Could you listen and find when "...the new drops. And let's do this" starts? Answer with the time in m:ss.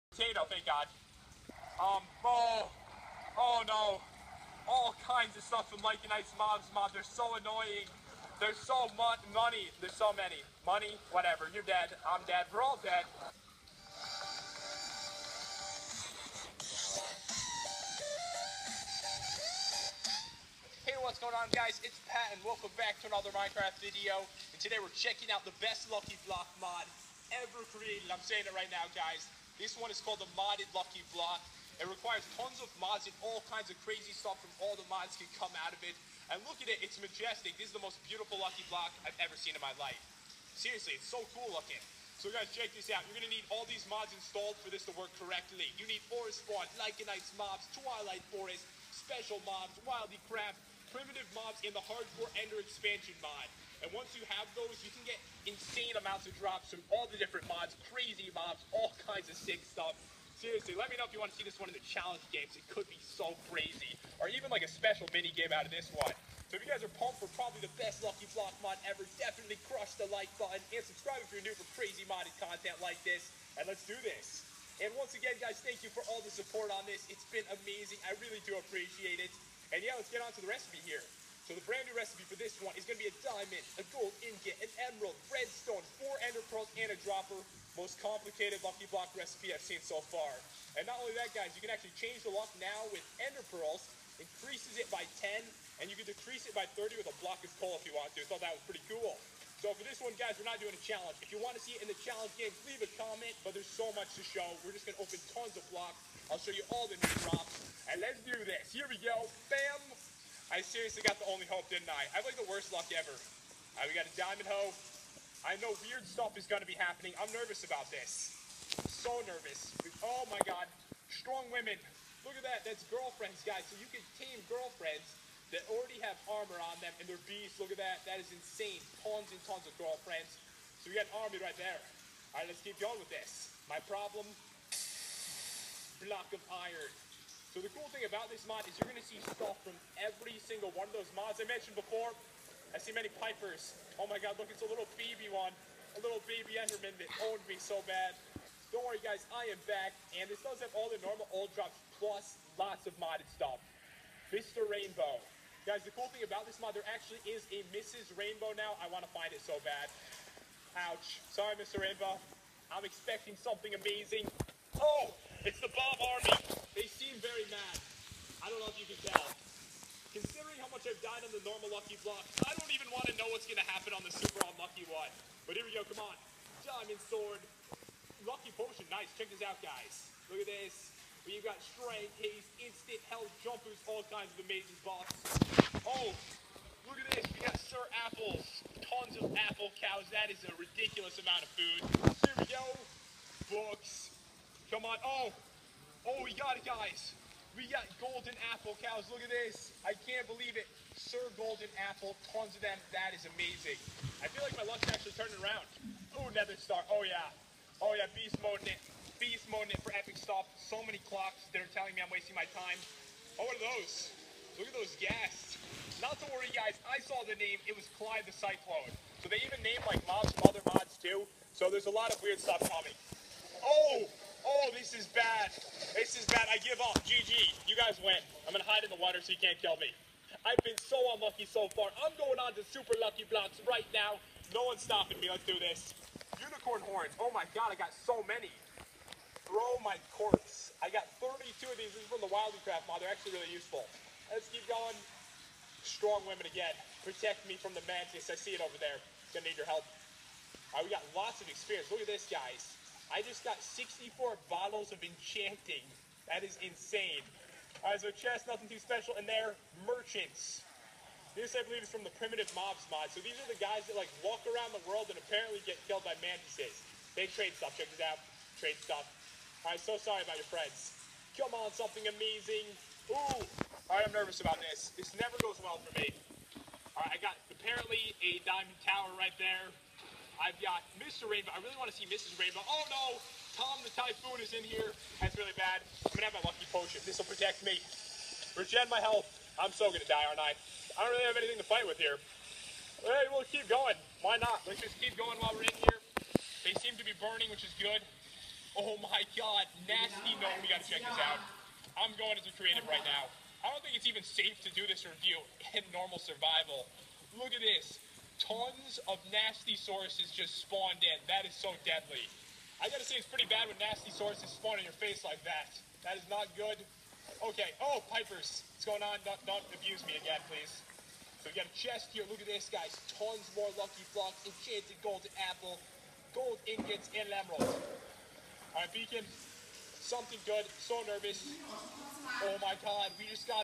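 1:46.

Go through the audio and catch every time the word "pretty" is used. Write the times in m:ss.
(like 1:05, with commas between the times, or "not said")
1:38, 5:13.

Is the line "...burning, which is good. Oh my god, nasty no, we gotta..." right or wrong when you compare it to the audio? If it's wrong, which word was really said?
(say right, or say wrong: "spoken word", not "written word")
right.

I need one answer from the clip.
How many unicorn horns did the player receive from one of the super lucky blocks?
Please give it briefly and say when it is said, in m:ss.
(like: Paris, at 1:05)
32, at 4:01.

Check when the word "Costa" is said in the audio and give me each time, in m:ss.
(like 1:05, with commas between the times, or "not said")
not said.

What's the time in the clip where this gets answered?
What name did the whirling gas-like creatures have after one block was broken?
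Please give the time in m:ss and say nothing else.
3:37.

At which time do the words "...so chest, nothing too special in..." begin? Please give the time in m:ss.
4:17.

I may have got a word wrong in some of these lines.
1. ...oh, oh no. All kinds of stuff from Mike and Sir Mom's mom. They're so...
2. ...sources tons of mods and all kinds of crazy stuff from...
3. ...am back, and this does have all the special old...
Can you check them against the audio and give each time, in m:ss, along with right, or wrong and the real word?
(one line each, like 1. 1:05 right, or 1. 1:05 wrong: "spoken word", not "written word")
1. 0:02 wrong: "Ice", not "Sir"
2. 0:31 wrong: "requires", not "sources"
3. 2:29 wrong: "normal", not "special".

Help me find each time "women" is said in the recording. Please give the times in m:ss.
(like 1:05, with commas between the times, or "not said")
2:01, 4:06.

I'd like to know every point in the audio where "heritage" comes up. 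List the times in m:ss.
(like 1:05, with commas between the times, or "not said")
not said.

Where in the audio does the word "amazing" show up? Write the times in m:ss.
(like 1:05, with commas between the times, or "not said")
1:17, 2:43, 3:04, 3:23, 4:32.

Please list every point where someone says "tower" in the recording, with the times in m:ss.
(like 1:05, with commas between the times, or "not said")
4:38.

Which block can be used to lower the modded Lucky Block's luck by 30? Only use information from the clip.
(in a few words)
Block of coal.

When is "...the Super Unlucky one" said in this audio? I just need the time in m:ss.
2:54.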